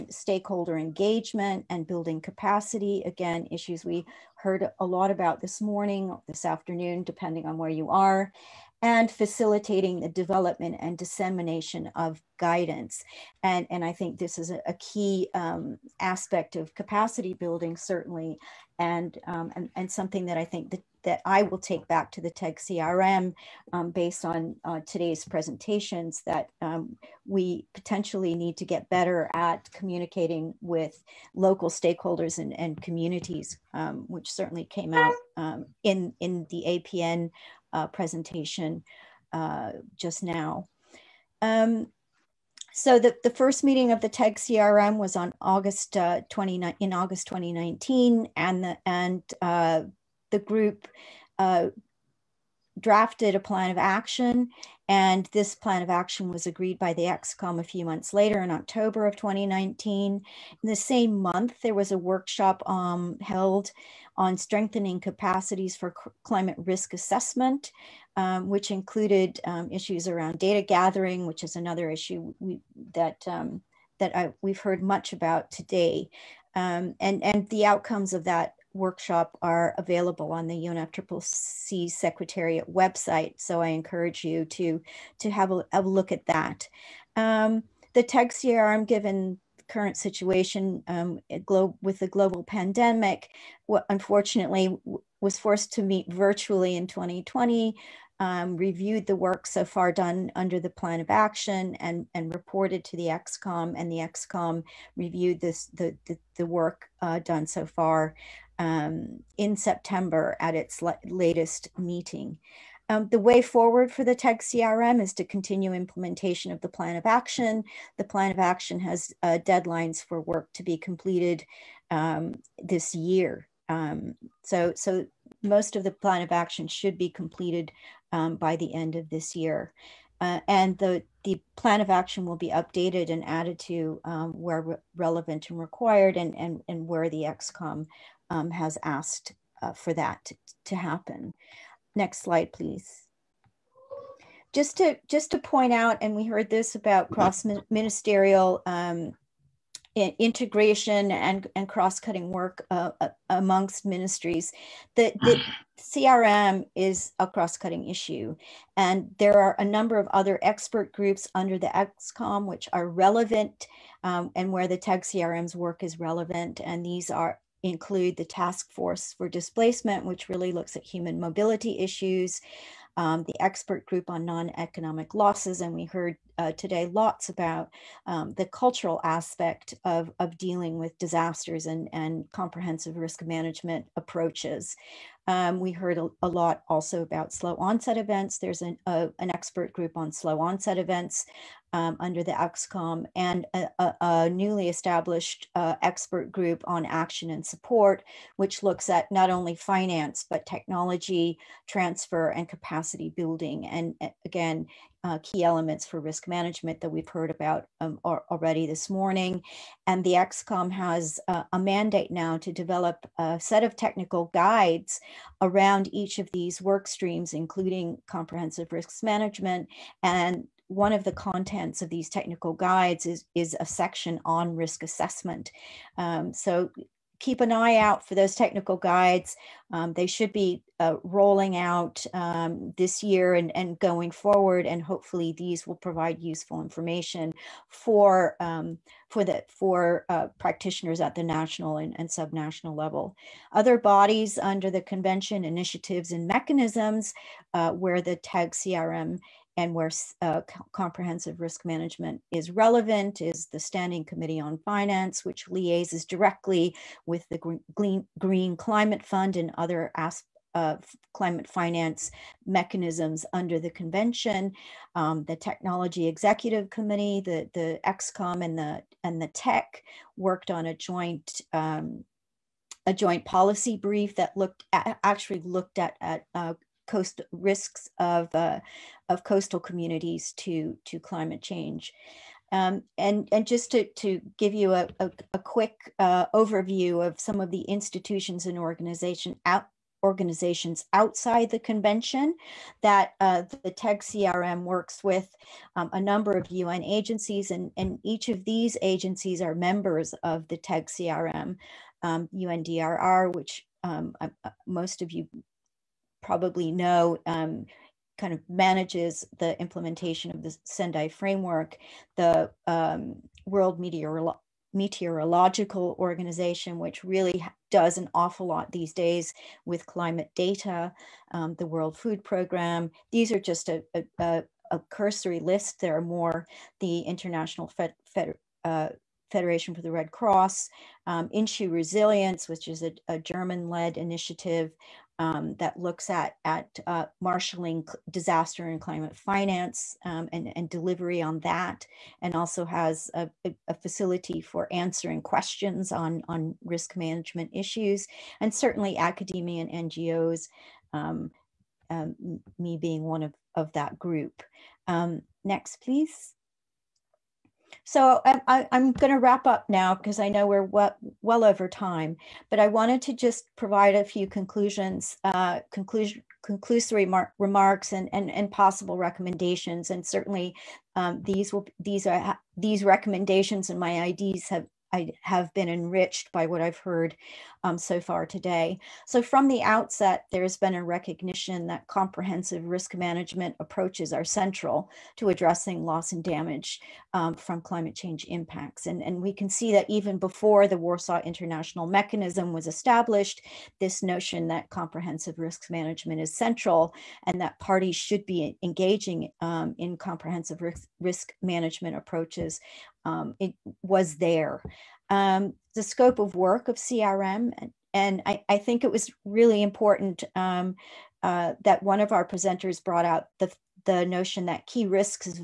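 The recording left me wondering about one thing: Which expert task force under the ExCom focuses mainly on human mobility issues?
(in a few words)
Task Force for Displacement.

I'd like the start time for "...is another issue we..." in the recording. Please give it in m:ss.
1:11.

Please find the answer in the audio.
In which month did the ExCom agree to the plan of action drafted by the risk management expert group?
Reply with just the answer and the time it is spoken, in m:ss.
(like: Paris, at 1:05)
October, at 0:58.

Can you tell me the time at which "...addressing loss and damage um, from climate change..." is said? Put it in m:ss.
6:25.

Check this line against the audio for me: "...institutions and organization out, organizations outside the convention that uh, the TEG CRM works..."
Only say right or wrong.
right.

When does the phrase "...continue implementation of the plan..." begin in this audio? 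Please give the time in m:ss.
1:55.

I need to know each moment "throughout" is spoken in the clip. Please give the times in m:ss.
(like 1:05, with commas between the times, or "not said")
not said.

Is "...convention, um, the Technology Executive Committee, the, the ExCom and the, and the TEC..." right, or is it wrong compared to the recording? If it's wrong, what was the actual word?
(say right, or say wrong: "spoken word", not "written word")
right.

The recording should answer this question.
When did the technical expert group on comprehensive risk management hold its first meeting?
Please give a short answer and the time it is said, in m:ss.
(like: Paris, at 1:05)
August 2019, at 0:46.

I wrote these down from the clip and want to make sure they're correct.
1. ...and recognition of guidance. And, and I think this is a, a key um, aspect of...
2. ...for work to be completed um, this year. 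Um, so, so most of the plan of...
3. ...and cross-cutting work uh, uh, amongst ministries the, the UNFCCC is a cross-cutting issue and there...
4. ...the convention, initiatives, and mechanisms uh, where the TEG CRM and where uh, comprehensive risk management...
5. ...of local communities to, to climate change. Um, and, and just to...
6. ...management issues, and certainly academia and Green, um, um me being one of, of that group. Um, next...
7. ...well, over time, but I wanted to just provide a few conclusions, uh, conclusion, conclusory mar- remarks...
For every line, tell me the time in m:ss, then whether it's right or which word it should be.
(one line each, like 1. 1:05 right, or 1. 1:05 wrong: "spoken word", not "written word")
1. 0:10 wrong: "dissemination", not "recognition"
2. 2:00 right
3. 2:31 wrong: "CRM", not "UNFCCC"
4. 4:04 right
5. 4:39 wrong: "coastal", not "local"
6. 5:46 wrong: "NGOs", not "Green"
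7. 6:01 right.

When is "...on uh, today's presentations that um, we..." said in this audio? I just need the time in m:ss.
0:24.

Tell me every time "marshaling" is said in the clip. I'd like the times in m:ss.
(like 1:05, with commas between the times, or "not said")
5:37.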